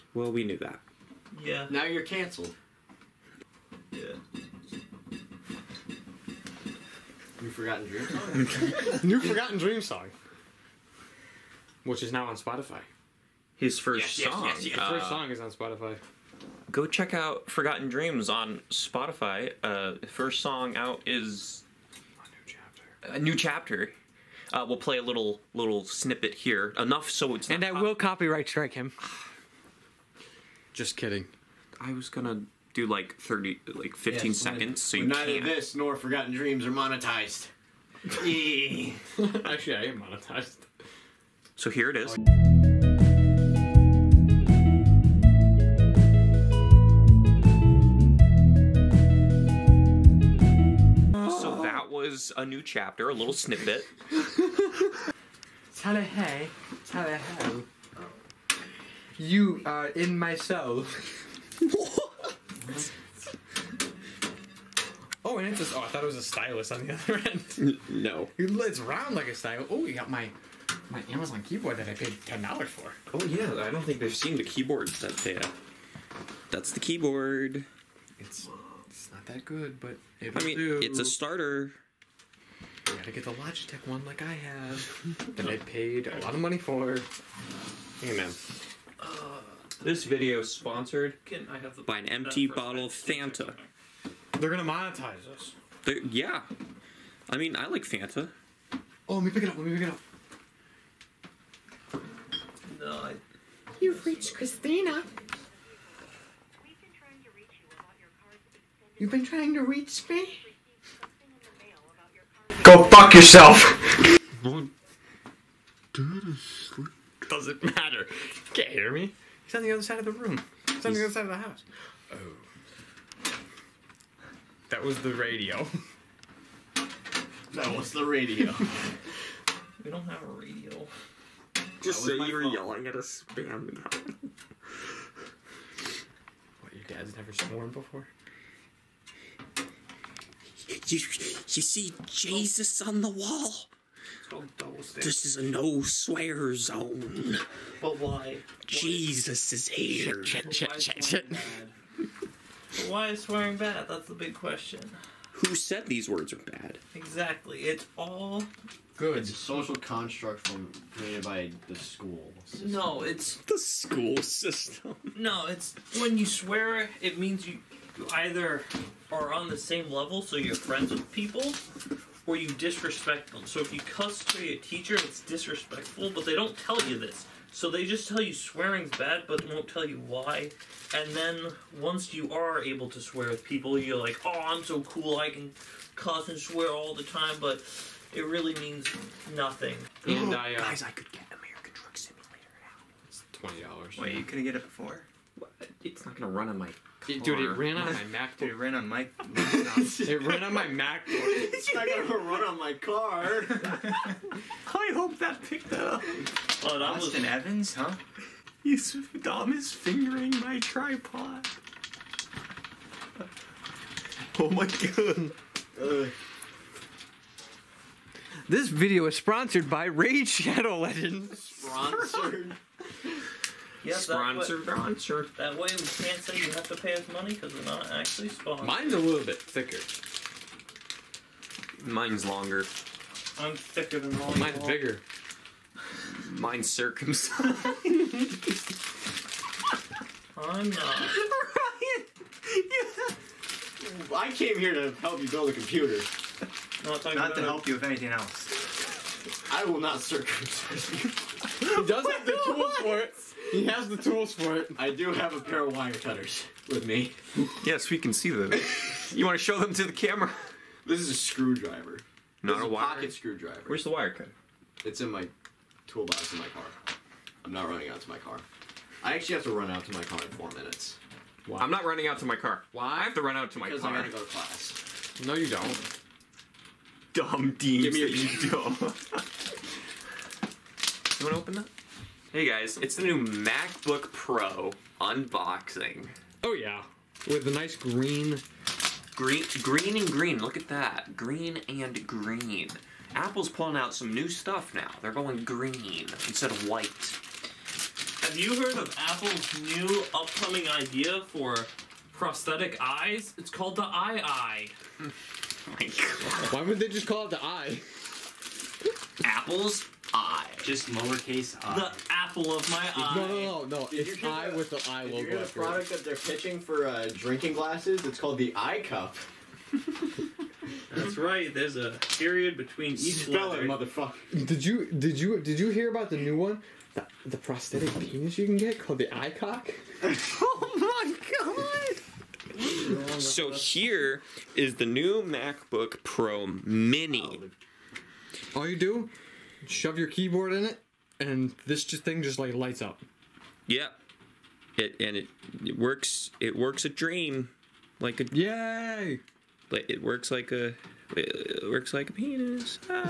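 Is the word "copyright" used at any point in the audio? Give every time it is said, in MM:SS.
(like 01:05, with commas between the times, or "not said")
00:27.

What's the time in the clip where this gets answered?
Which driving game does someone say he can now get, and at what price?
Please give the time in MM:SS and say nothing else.
03:11.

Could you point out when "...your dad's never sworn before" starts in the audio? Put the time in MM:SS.
02:16.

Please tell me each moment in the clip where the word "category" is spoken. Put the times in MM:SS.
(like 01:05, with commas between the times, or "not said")
not said.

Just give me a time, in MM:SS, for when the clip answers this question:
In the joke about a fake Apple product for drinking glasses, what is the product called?
05:18.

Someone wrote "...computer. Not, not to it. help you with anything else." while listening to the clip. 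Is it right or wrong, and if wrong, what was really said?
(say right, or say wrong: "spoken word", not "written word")
right.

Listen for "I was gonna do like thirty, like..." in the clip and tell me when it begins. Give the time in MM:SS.
00:31.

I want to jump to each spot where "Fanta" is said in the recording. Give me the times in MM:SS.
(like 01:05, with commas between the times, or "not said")
01:32, 01:37.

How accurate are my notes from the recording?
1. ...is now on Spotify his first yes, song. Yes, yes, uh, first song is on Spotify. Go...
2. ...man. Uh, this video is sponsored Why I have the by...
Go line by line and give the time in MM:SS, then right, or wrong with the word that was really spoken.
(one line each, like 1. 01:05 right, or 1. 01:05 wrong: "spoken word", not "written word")
1. 00:12 right
2. 01:28 wrong: "Can", not "Why".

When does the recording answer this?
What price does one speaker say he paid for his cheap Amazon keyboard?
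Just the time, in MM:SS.
01:12.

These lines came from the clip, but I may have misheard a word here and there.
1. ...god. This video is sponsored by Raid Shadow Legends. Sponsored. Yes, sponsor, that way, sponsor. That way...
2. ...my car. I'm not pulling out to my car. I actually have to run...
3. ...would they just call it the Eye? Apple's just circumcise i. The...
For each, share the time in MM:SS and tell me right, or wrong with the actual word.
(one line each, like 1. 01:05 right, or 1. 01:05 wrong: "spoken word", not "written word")
1. 03:34 right
2. 04:26 wrong: "running", not "pulling"
3. 05:06 wrong: "lowercase", not "circumcise".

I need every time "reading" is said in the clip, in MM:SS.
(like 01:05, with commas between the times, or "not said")
not said.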